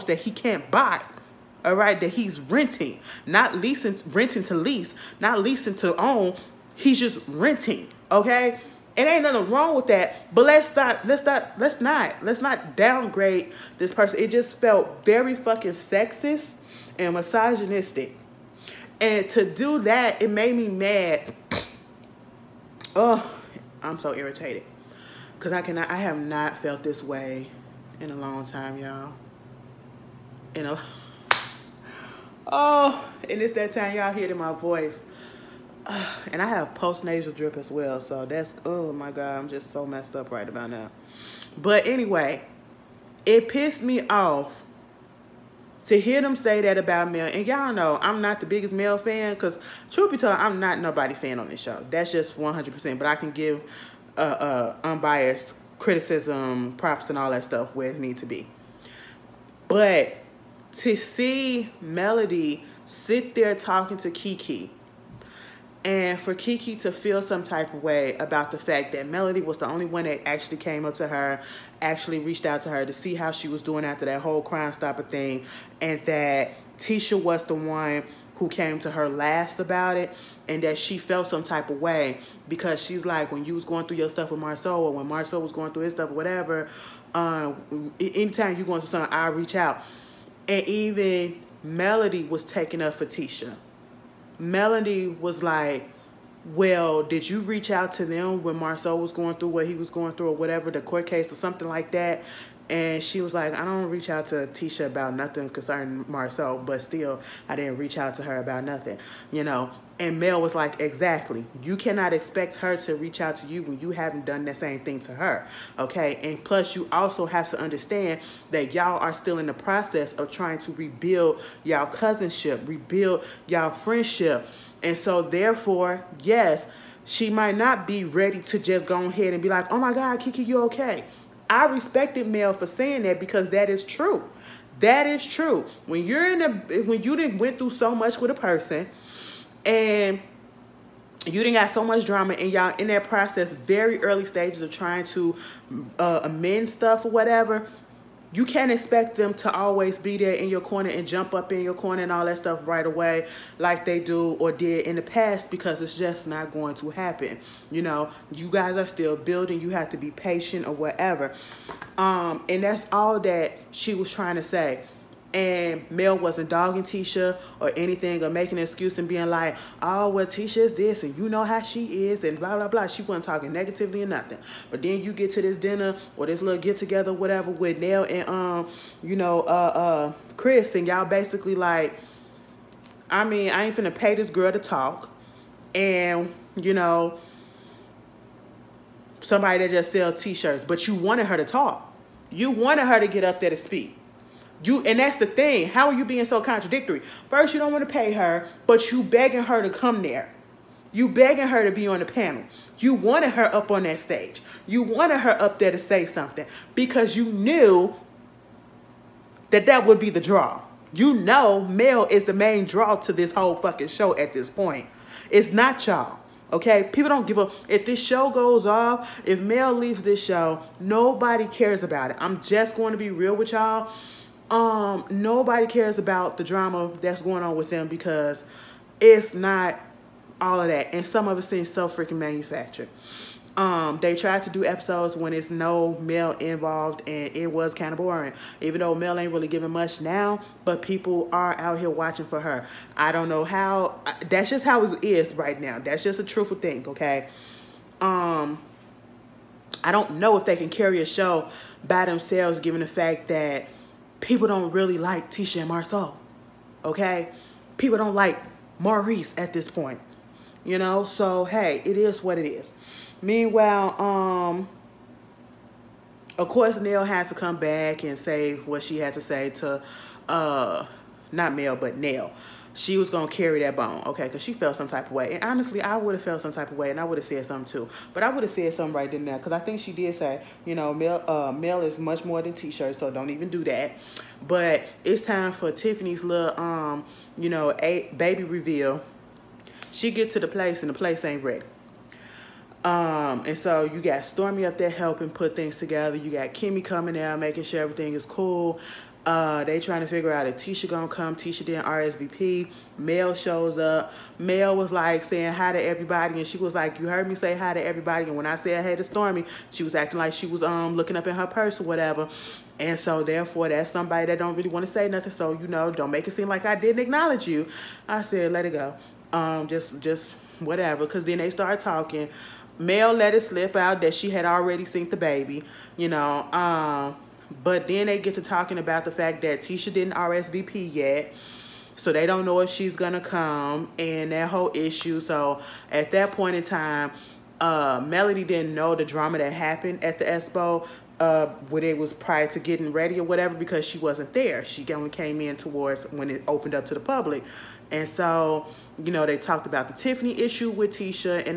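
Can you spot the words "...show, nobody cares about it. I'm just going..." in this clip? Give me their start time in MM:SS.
03:40.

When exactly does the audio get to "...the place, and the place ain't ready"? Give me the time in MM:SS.
04:50.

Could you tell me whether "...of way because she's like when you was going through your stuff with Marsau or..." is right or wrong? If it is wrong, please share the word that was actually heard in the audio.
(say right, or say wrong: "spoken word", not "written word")
right.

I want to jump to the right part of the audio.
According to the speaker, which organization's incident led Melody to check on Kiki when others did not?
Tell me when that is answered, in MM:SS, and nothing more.
01:14.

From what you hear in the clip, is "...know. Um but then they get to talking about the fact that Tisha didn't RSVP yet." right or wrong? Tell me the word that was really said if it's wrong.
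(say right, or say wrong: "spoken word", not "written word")
right.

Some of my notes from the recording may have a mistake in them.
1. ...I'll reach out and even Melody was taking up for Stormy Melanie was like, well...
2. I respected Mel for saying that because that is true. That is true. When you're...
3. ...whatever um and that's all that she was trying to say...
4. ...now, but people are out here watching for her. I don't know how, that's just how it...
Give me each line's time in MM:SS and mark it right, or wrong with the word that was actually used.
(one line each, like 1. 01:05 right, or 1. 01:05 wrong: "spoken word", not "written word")
1. 01:29 wrong: "Tisha", not "Stormy"
2. 02:11 right
3. 02:40 right
4. 03:59 right.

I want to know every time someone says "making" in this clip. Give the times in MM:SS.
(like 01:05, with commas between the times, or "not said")
02:48, 04:57.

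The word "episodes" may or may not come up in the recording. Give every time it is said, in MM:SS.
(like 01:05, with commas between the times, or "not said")
03:54.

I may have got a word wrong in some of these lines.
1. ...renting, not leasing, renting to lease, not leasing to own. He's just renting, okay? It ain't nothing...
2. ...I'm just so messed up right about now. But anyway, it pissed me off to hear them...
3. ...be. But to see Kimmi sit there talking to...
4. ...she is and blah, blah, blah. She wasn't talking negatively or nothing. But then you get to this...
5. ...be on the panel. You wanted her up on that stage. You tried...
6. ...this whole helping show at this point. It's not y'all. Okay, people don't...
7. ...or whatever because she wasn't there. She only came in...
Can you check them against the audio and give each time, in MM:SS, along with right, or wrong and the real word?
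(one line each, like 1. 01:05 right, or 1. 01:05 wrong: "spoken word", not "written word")
1. 00:02 right
2. 00:39 right
3. 00:58 wrong: "Melody", not "Kimmi"
4. 02:51 right
5. 03:21 wrong: "wanted", not "tried"
6. 03:33 wrong: "fucking", not "helping"
7. 05:43 right.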